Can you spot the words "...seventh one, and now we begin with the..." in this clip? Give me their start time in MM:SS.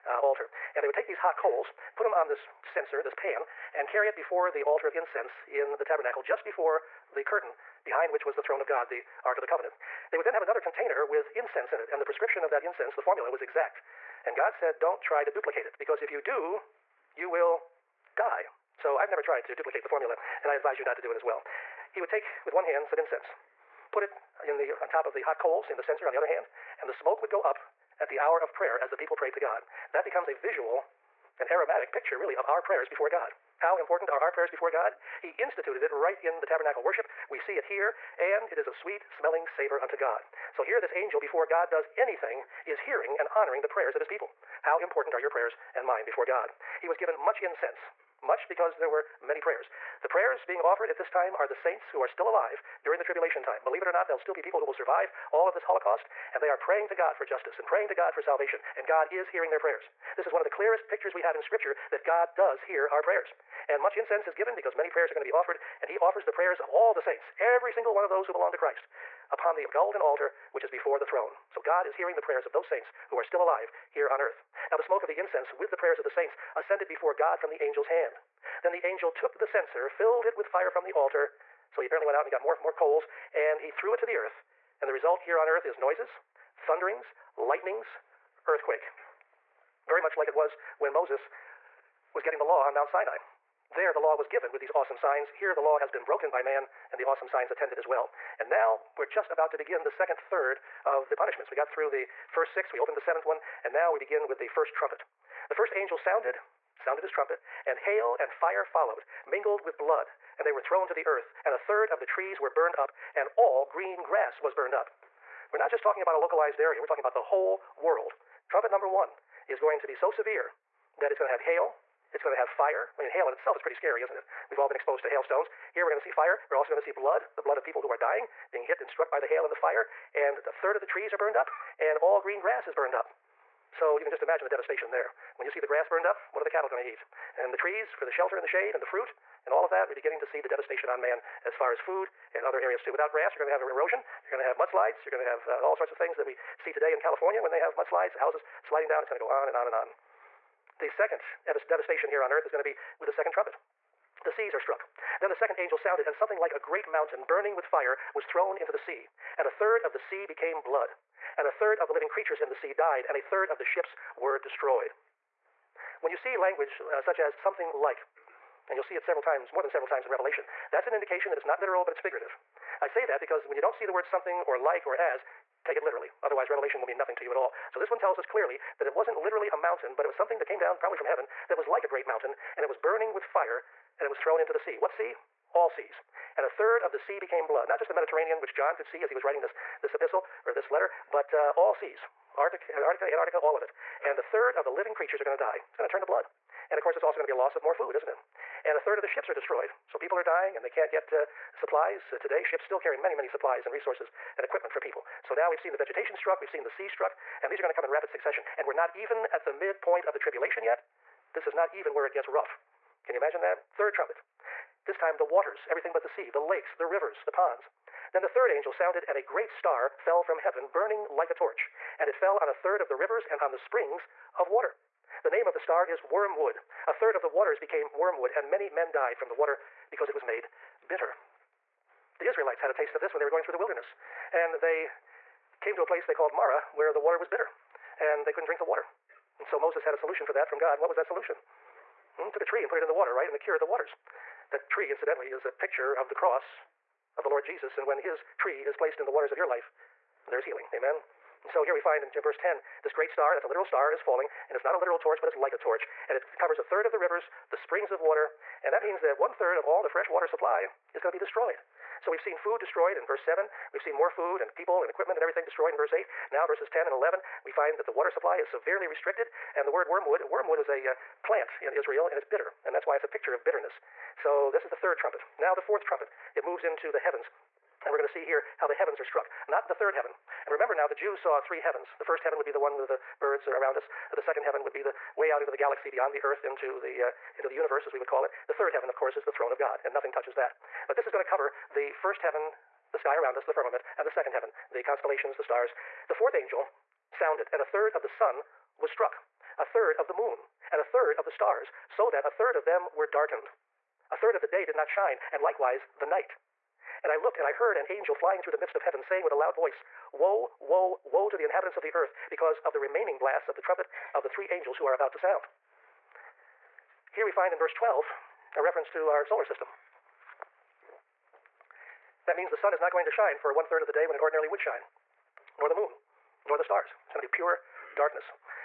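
01:42.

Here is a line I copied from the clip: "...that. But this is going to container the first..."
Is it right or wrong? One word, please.
wrong.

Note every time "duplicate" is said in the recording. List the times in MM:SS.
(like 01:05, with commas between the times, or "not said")
00:15, 00:19.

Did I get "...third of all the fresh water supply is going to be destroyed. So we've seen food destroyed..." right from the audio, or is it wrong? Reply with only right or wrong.
right.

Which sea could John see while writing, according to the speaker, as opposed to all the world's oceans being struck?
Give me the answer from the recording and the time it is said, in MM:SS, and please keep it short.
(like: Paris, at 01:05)
Mediterranean, at 03:07.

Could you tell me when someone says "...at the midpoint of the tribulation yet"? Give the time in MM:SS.
03:29.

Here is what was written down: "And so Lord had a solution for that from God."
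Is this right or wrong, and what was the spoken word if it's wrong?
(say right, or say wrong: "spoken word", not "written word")
wrong: "Moses", not "Lord".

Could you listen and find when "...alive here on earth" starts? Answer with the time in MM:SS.
01:13.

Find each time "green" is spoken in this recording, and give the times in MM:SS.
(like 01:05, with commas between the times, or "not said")
01:53, 02:12.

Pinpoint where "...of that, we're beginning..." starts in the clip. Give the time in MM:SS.
02:19.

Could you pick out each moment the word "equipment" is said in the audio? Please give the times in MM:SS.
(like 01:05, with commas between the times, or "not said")
03:24, 04:24.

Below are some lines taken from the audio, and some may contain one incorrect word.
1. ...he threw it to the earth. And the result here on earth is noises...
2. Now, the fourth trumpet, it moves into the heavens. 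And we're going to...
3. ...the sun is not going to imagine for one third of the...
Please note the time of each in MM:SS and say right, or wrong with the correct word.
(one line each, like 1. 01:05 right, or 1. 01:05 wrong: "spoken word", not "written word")
1. 01:23 right
2. 04:35 right
3. 05:22 wrong: "shine", not "imagine".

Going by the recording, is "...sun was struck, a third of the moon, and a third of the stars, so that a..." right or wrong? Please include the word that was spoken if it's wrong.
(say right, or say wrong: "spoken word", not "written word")
right.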